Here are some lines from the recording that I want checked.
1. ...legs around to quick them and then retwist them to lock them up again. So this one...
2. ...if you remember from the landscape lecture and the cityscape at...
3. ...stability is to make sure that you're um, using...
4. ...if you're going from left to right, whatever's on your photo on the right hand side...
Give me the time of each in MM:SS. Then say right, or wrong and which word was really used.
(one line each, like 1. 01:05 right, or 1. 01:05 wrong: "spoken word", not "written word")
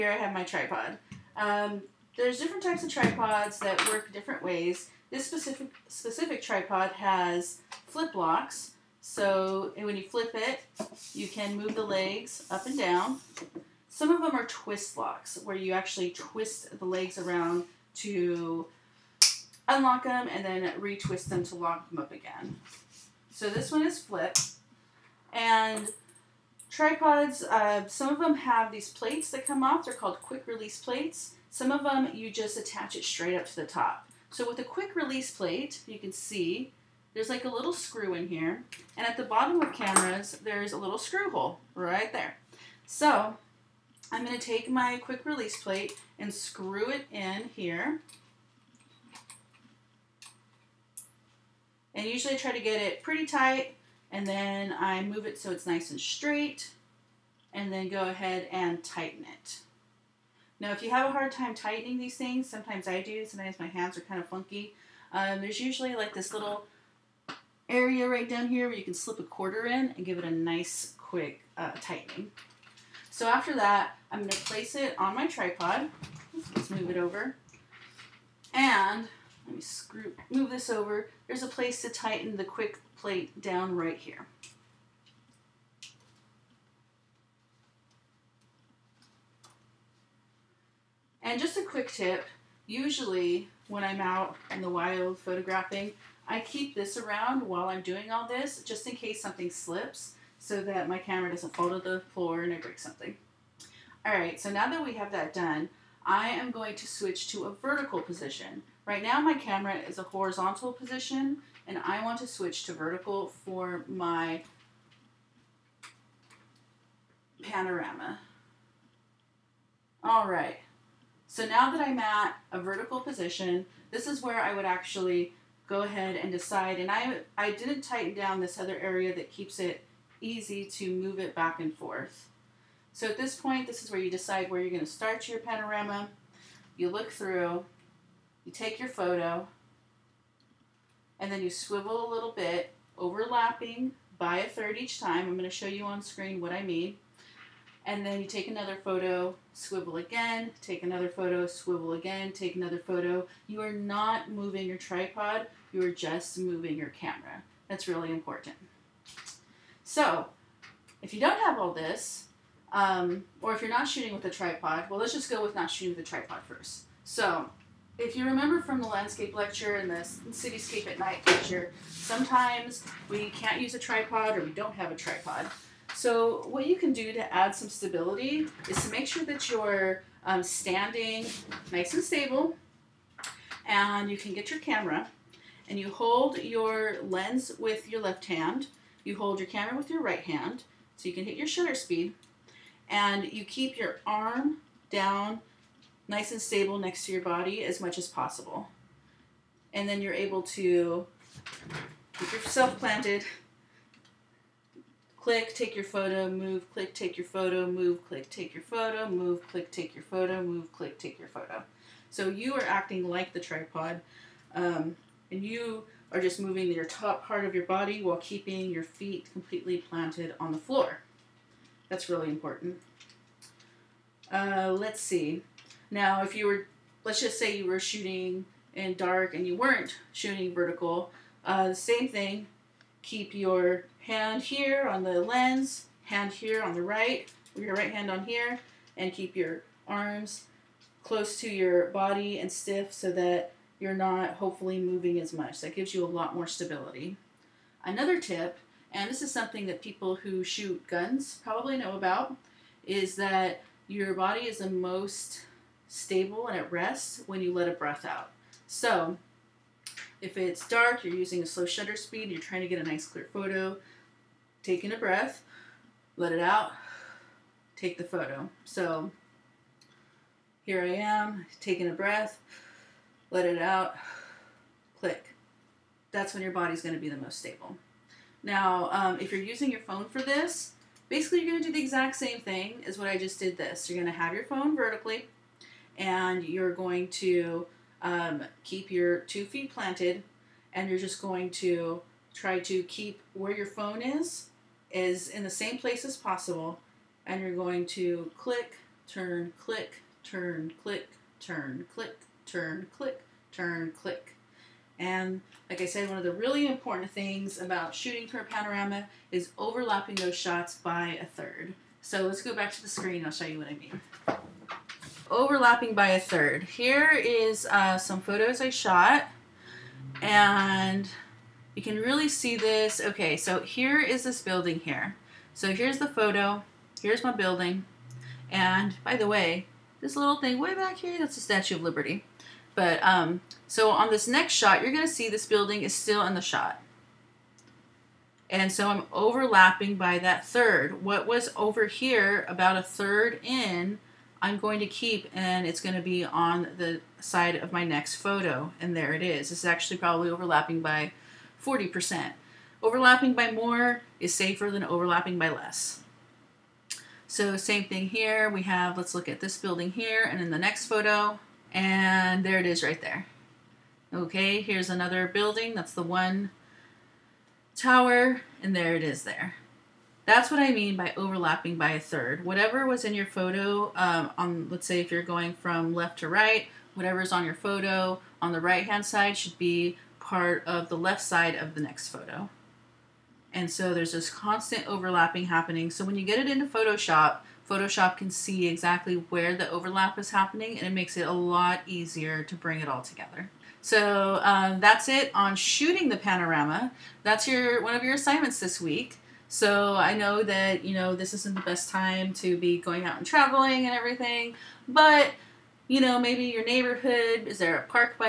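1. 00:16 wrong: "unlock", not "quick"
2. 02:47 right
3. 02:57 wrong: "standing", not "using"
4. 06:14 right.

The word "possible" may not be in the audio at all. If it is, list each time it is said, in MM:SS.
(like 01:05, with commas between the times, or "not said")
03:18, 04:56.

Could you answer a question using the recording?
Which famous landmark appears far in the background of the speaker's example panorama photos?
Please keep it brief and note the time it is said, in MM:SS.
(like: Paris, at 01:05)
Statue of Liberty, at 05:31.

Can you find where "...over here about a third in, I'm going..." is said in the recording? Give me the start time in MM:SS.
05:41.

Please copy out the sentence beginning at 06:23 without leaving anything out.
And so there's this constant overlapping happening.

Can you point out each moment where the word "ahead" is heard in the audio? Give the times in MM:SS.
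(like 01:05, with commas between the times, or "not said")
00:58, 02:05.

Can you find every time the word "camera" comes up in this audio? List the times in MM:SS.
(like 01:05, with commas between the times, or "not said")
00:39, 01:40, 01:49, 02:36, 03:04, 03:09.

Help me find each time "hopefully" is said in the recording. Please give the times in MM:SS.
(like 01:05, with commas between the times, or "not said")
04:04.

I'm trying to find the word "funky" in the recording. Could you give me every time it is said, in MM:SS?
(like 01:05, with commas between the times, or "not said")
01:04.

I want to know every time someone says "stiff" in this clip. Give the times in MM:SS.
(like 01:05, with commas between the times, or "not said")
04:02.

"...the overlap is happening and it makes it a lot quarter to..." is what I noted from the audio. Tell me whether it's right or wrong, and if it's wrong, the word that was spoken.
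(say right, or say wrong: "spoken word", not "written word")
wrong: "easier", not "quarter".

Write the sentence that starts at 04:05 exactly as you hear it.
That gives you a lot more stability.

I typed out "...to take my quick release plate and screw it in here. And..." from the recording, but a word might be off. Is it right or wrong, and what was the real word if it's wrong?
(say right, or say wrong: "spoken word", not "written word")
right.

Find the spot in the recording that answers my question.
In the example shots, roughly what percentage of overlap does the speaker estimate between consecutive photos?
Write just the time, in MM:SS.
05:51.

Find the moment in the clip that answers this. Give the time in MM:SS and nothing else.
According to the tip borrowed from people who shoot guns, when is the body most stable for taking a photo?
04:17.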